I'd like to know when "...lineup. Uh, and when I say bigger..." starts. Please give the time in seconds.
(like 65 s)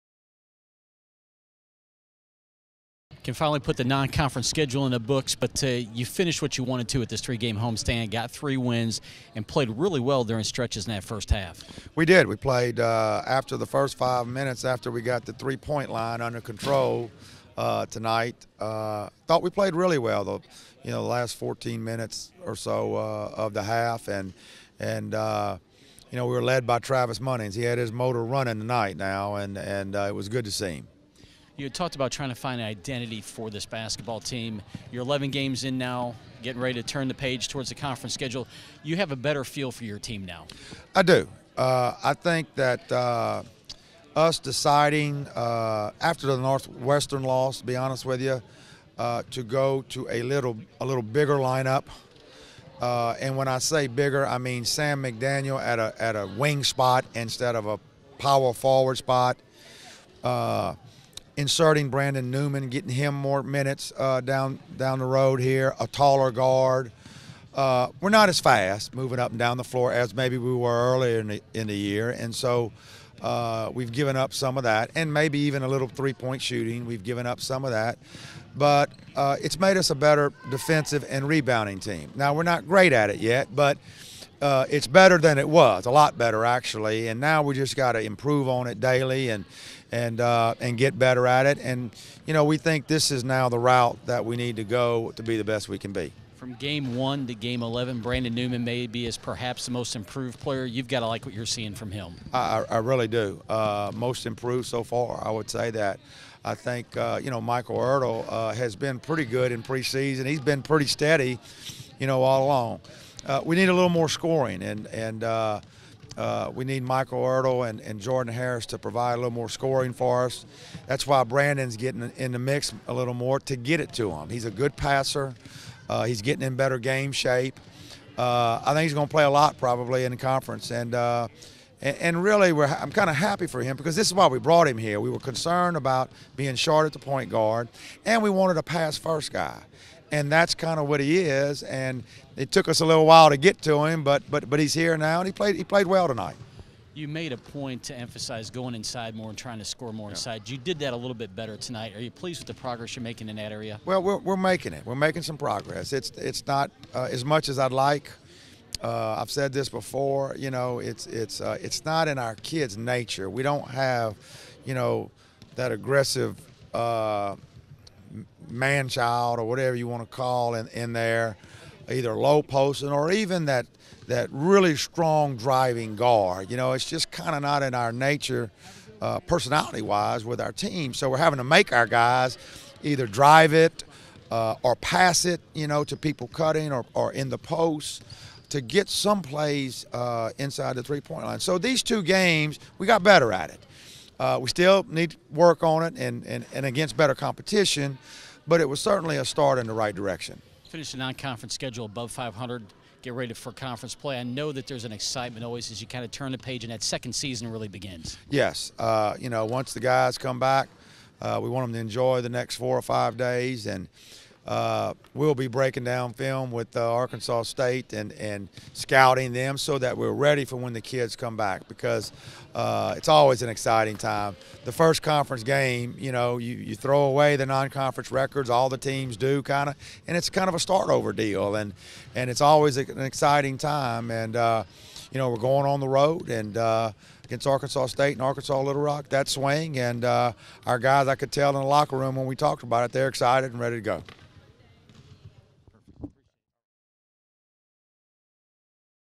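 51 s.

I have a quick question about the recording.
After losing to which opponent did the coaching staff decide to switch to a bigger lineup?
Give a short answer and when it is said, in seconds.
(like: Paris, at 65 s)
Northwestern, at 46 s.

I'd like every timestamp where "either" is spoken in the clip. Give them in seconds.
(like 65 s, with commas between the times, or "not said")
171 s, 182 s.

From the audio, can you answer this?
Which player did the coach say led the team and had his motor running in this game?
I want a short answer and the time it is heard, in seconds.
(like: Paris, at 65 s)
Travis Munnings, at 26 s.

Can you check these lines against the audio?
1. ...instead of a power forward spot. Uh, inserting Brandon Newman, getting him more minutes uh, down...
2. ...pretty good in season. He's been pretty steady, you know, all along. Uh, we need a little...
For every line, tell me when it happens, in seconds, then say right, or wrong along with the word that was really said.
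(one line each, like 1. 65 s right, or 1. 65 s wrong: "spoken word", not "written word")
1. 57 s right
2. 108 s wrong: "preseason", not "season".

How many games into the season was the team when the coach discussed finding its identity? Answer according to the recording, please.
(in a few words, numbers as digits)
11.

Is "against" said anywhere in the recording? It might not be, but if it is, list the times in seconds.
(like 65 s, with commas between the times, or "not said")
196 s, 237 s.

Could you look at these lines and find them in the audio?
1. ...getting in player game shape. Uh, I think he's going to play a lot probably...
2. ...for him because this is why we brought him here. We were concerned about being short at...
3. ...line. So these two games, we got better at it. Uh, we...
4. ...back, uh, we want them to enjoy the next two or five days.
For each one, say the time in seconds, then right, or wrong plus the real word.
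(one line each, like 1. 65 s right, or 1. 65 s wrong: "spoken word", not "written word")
1. 126 s wrong: "better", not "player"
2. 133 s right
3. 191 s right
4. 210 s wrong: "four", not "two".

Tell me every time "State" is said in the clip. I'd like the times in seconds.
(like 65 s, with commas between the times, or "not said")
217 s, 237 s.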